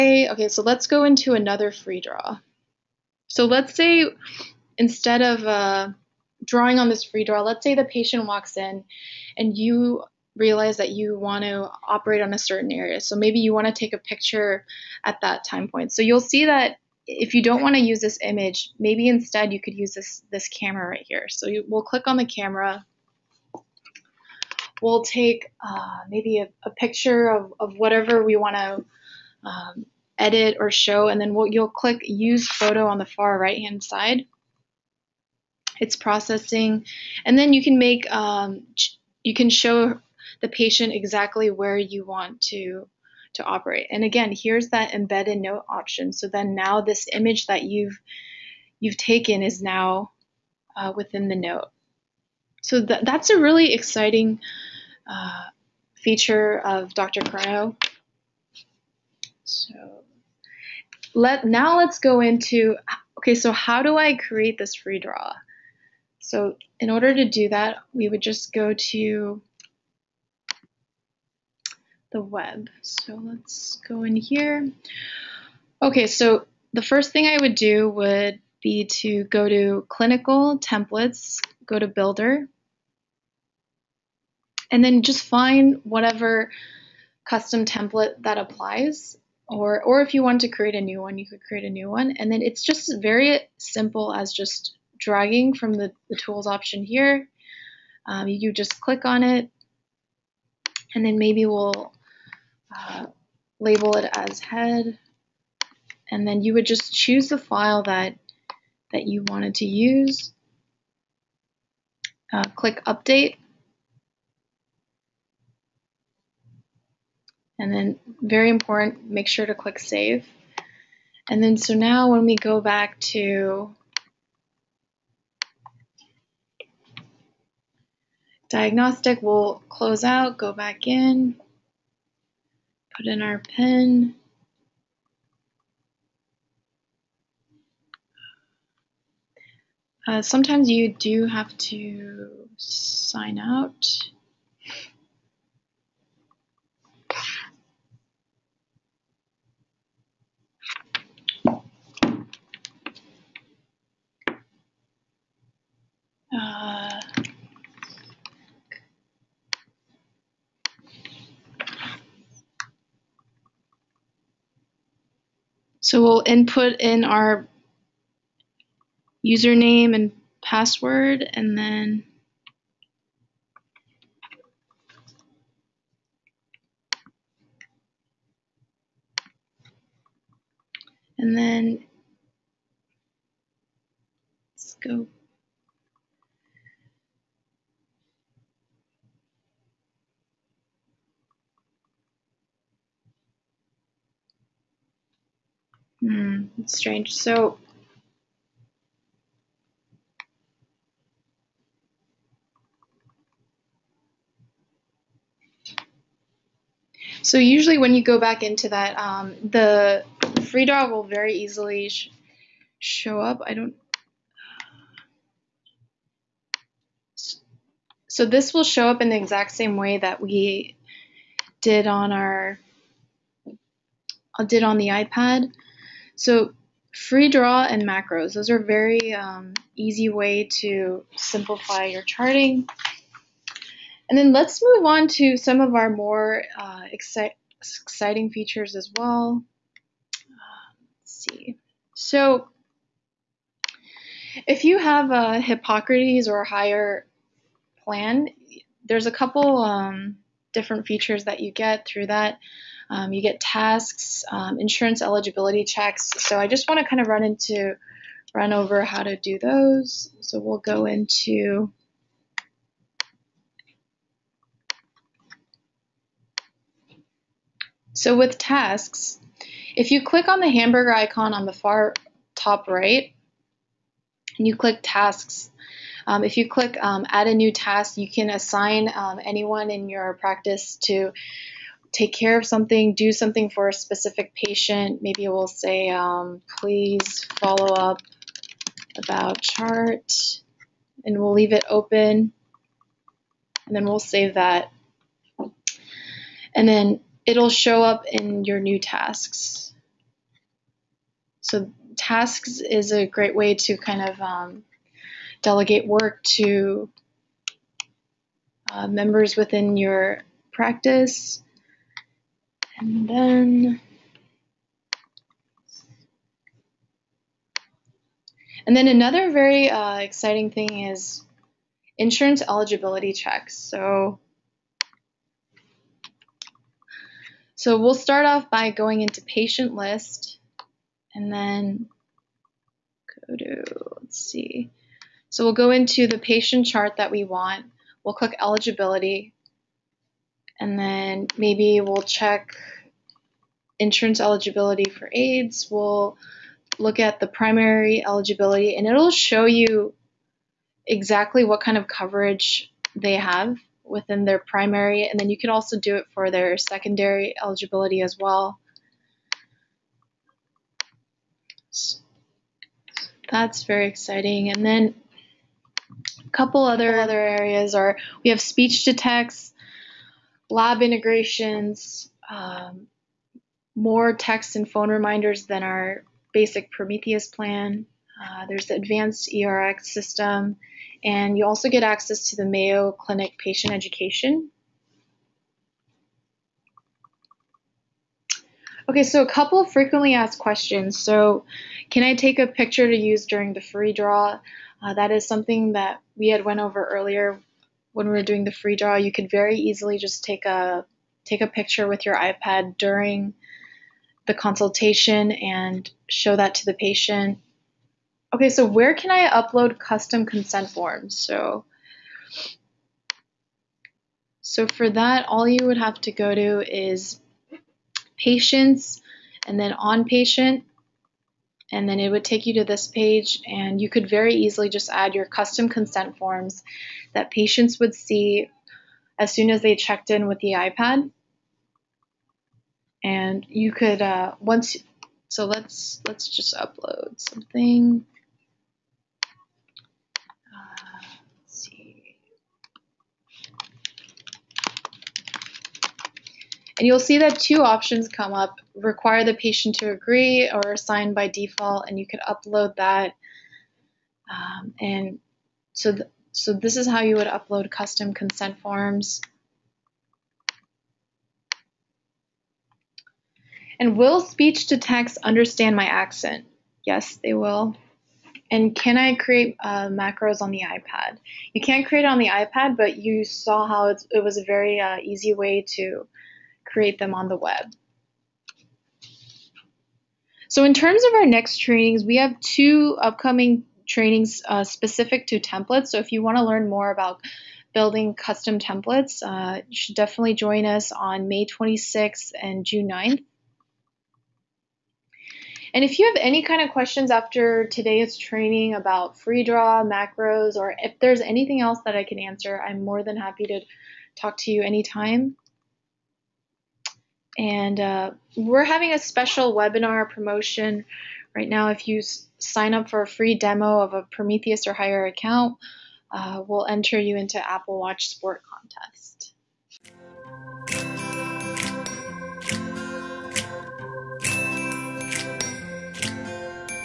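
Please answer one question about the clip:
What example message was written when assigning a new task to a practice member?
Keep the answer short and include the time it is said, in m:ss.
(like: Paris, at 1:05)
please follow up about chart, at 4:46.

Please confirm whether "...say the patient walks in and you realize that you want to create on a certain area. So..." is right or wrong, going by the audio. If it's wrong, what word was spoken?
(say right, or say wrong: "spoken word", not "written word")
wrong: "operate", not "create".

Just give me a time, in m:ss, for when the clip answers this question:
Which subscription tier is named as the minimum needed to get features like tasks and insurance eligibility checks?
4:05.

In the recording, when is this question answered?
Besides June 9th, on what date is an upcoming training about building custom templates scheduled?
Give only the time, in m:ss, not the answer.
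8:11.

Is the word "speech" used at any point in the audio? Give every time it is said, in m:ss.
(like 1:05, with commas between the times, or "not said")
6:08, 7:44.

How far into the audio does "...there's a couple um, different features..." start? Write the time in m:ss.
4:08.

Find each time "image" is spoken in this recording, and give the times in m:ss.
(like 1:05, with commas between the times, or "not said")
0:18, 0:47.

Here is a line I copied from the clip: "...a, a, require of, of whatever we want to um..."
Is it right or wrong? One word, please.
wrong.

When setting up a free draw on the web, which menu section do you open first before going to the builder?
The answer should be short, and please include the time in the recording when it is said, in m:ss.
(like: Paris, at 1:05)
clinical templates, at 1:19.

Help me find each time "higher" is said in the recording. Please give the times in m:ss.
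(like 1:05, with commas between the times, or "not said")
4:06, 8:34.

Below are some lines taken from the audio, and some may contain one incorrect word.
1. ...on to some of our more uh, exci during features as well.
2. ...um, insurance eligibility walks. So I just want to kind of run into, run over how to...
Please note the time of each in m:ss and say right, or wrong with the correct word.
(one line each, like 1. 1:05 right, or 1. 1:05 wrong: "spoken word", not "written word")
1. 3:54 wrong: "exciting", not "during"
2. 4:14 wrong: "checks", not "walks".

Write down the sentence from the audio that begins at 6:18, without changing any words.
Uh, there's the advanced ERX system, and you also get access to the Mayo Clinic patient education.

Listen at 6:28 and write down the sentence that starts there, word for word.
Okay, so a couple of frequently asked questions.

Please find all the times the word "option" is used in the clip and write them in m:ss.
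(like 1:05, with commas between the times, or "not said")
0:45, 1:36, 7:27.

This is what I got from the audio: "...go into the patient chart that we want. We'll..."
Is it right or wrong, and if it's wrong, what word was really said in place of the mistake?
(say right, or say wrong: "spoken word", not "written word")
right.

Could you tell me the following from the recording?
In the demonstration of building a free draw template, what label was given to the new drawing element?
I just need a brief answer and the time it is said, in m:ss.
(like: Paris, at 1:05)
head, at 1:44.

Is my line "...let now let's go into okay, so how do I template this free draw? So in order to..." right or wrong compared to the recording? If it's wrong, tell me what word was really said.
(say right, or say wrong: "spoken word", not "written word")
wrong: "create", not "template".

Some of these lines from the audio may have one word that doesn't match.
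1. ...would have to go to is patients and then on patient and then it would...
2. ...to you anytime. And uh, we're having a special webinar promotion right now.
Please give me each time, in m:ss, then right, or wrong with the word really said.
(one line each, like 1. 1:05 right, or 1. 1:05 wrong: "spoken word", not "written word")
1. 6:55 right
2. 8:24 right.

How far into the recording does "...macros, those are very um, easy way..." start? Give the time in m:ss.
3:47.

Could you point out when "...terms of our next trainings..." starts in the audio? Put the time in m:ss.
8:00.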